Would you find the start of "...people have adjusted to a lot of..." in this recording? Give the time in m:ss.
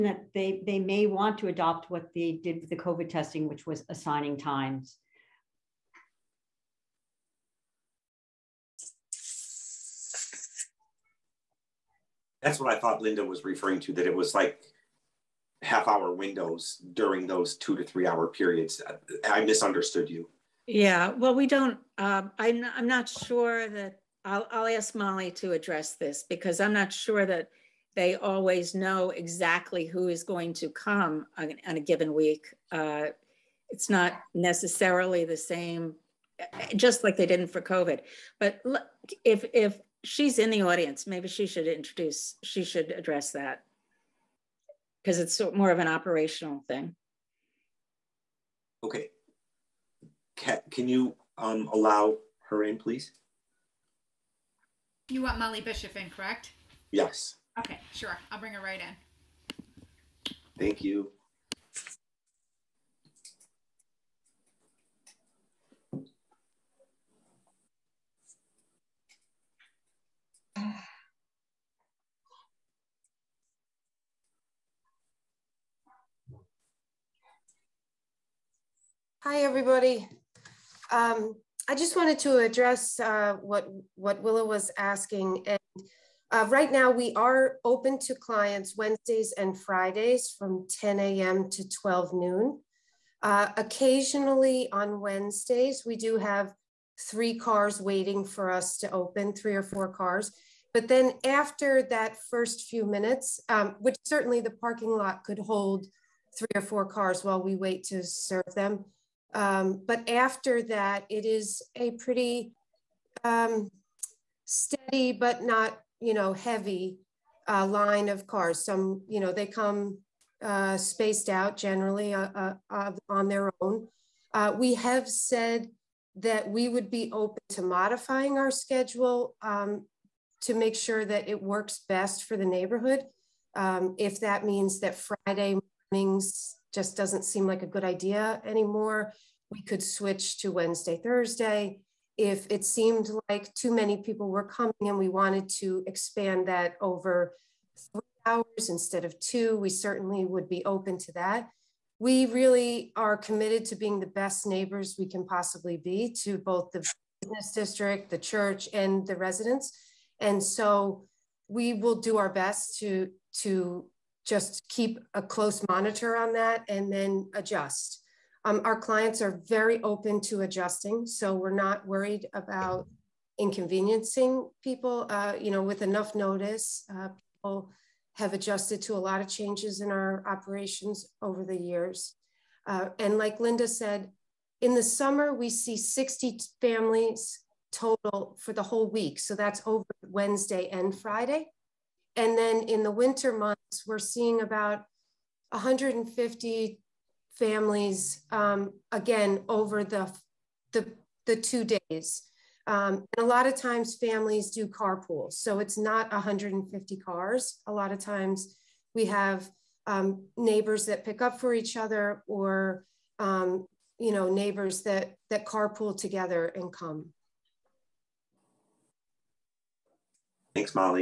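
2:57.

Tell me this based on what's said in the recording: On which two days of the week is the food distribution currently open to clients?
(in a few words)
Wednesdays and Fridays.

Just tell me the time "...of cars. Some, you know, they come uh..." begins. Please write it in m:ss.
1:58.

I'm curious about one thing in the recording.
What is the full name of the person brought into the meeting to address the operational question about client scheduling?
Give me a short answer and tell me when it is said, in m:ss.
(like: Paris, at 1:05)
Molly Bishop, at 0:55.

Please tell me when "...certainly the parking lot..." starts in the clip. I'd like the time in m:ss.
1:44.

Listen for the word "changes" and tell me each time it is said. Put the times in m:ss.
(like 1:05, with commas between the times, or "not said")
2:59.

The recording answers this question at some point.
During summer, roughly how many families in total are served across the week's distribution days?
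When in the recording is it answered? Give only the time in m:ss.
3:05.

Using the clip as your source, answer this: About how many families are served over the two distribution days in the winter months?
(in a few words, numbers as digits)
150.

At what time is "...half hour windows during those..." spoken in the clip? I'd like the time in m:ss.
0:15.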